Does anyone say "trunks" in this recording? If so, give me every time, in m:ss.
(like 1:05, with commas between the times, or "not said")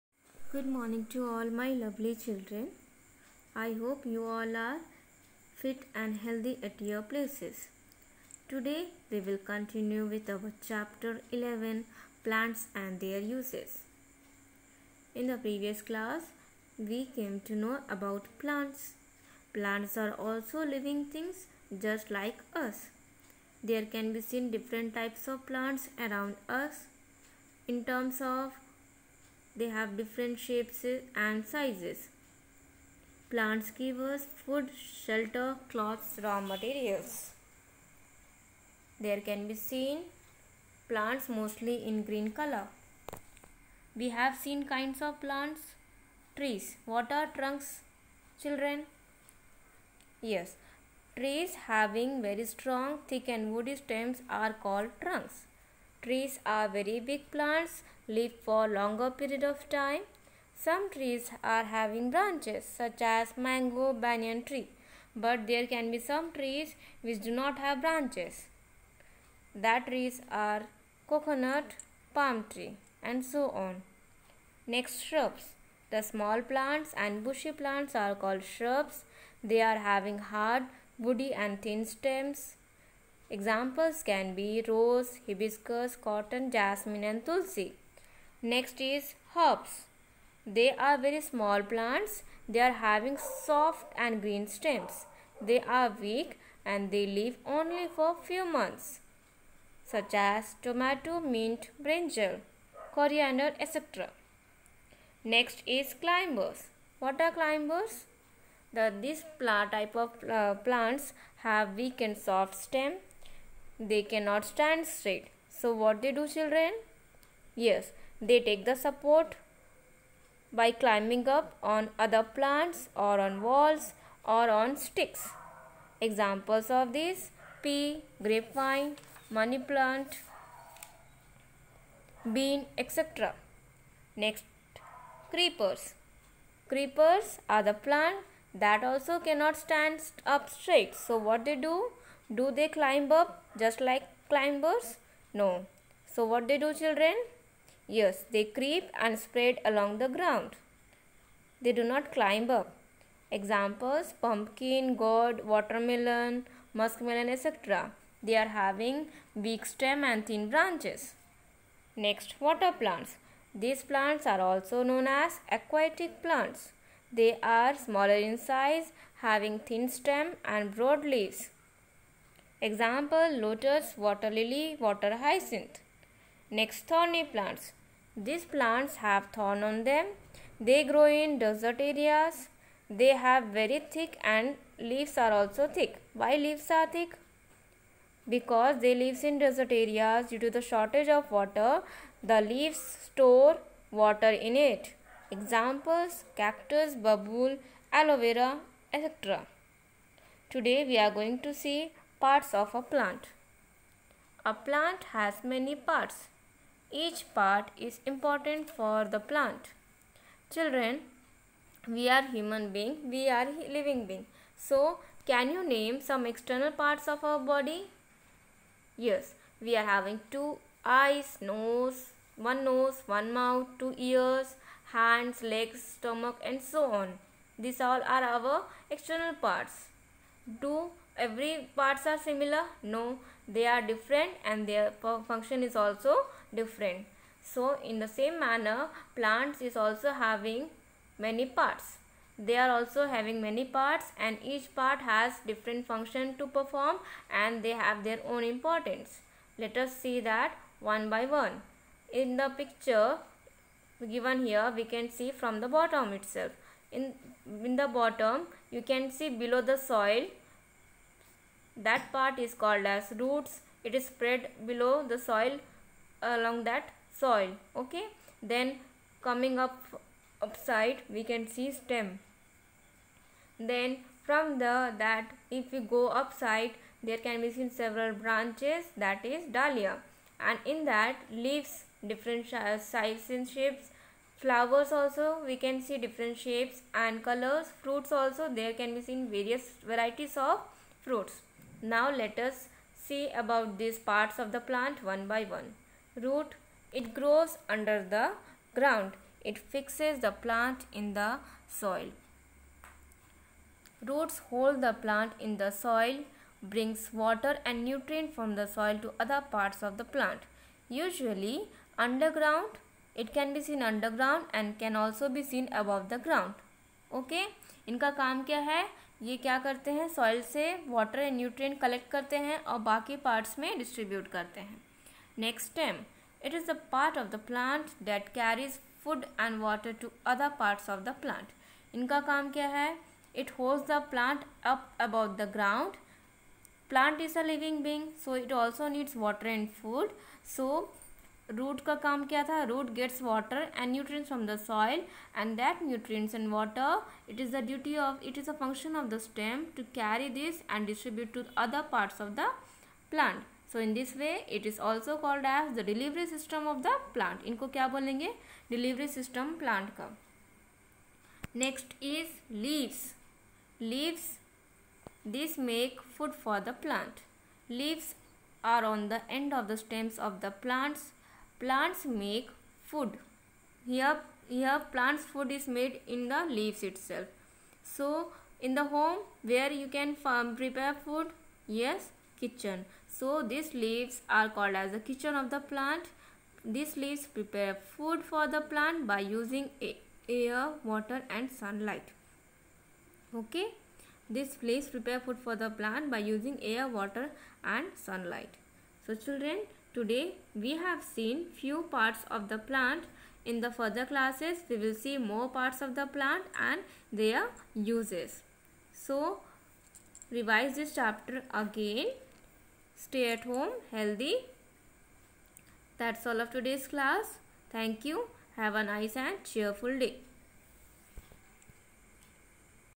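0:47, 0:55.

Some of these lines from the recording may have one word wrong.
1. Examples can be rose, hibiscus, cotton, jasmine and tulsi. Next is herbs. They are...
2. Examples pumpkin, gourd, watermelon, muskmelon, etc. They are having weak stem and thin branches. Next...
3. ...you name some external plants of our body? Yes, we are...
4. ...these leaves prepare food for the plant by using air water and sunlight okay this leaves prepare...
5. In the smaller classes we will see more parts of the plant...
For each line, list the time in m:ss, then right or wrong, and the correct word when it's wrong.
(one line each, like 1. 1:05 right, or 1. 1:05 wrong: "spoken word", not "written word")
1. 1:23 right
2. 2:33 right
3. 3:35 wrong: "parts", not "plants"
4. 6:26 right
5. 6:43 wrong: "further", not "smaller".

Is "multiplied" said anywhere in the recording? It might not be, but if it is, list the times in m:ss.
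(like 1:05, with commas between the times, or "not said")
not said.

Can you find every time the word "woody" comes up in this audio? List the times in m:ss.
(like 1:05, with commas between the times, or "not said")
0:53, 1:20.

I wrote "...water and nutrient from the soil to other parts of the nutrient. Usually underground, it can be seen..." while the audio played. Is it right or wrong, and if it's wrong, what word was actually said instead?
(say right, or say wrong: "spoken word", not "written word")
wrong: "plant", not "nutrient".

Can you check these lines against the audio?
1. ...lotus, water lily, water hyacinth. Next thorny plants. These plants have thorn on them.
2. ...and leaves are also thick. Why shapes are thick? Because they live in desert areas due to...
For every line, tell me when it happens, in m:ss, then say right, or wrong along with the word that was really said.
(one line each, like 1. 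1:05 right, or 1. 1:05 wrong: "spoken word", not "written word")
1. 2:53 right
2. 3:04 wrong: "leaves", not "shapes".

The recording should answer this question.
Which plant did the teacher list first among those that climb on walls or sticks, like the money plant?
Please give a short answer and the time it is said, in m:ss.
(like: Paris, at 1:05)
pea, at 2:07.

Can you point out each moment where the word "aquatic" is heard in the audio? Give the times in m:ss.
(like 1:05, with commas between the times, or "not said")
2:45.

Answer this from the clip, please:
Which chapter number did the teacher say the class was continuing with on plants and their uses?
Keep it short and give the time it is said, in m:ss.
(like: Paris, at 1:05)
11, at 0:10.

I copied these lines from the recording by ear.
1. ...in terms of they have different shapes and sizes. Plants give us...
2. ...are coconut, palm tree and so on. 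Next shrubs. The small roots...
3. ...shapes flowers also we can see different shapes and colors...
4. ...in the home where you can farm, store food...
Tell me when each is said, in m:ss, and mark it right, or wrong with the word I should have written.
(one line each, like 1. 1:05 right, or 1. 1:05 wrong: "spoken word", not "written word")
1. 0:27 right
2. 1:10 wrong: "plants", not "roots"
3. 4:43 right
4. 6:18 wrong: "prepare", not "store".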